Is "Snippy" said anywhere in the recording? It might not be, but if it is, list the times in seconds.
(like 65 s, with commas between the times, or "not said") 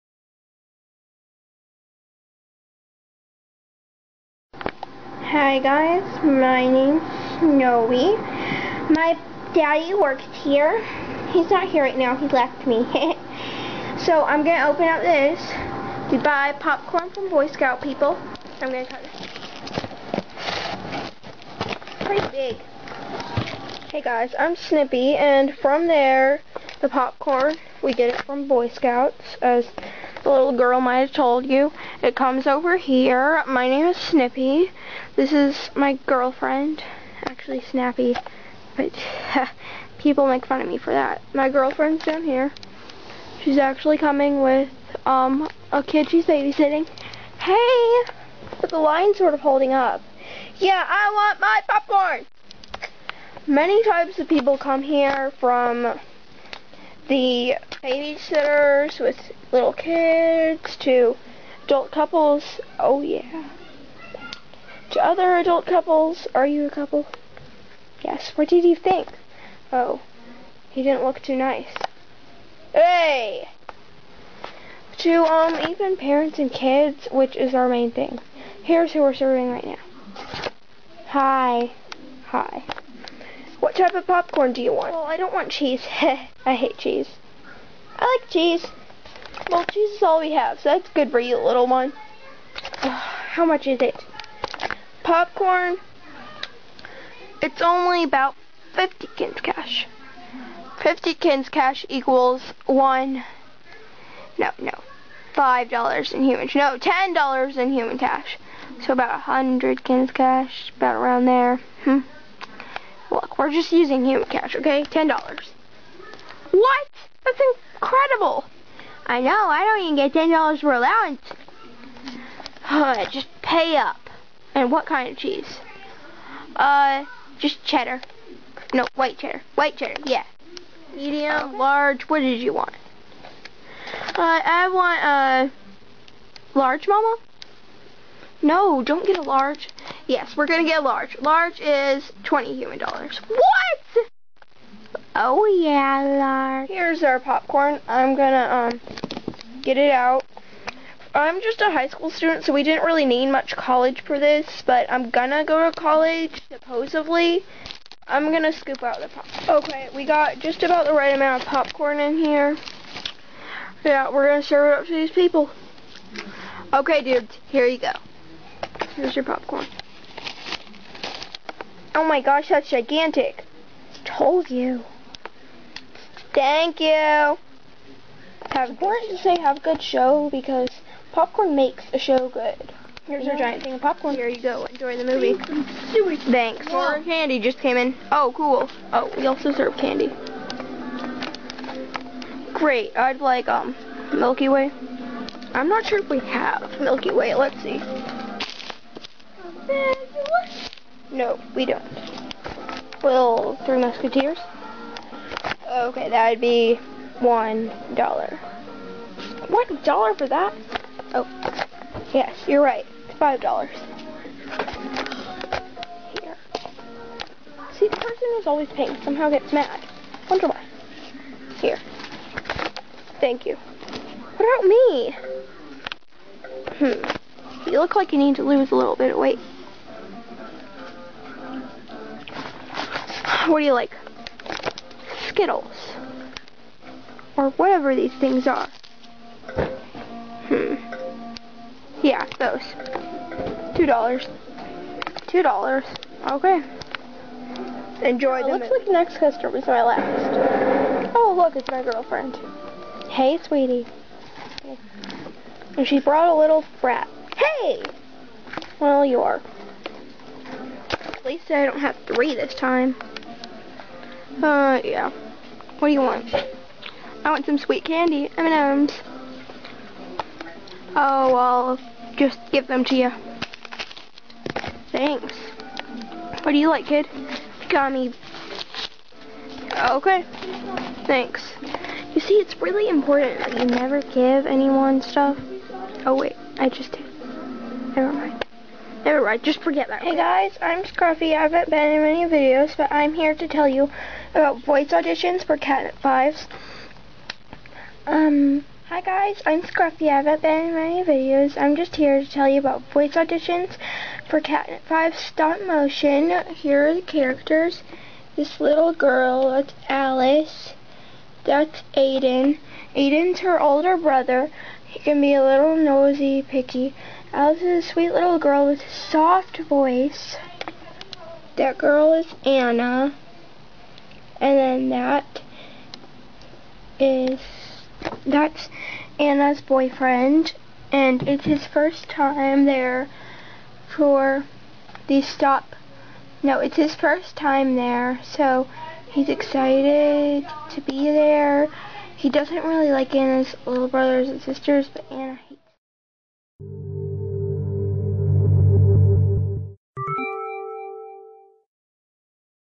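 24 s, 33 s.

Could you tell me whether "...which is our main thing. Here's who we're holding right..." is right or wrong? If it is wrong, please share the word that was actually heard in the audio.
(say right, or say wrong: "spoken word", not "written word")
wrong: "serving", not "holding".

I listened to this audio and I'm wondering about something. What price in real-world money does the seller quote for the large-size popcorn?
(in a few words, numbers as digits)
$20.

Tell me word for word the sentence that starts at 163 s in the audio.
Yeah, we're gonna serve it up to these people.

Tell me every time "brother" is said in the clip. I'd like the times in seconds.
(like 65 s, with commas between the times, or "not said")
313 s, 343 s.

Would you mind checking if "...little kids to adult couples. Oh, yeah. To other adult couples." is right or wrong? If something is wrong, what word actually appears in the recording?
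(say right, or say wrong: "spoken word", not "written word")
right.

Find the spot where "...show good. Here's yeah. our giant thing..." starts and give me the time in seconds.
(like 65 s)
181 s.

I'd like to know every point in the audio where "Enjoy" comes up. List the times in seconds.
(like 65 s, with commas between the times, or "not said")
184 s, 248 s.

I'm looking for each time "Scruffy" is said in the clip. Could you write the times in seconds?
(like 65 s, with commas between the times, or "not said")
290 s, 299 s.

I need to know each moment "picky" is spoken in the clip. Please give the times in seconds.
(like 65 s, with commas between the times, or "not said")
316 s.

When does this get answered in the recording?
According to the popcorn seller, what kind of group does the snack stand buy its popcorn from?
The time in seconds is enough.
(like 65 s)
17 s.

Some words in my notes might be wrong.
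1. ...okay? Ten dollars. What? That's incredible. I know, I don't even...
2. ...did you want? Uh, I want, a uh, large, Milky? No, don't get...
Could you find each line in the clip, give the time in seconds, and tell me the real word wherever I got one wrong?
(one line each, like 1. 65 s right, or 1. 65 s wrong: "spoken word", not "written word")
1. 114 s right
2. 132 s wrong: "Mama", not "Milky".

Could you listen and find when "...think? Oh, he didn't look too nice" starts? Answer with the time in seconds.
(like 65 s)
68 s.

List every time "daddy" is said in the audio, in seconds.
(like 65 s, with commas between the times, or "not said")
9 s.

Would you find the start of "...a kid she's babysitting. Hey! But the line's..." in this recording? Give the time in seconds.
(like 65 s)
45 s.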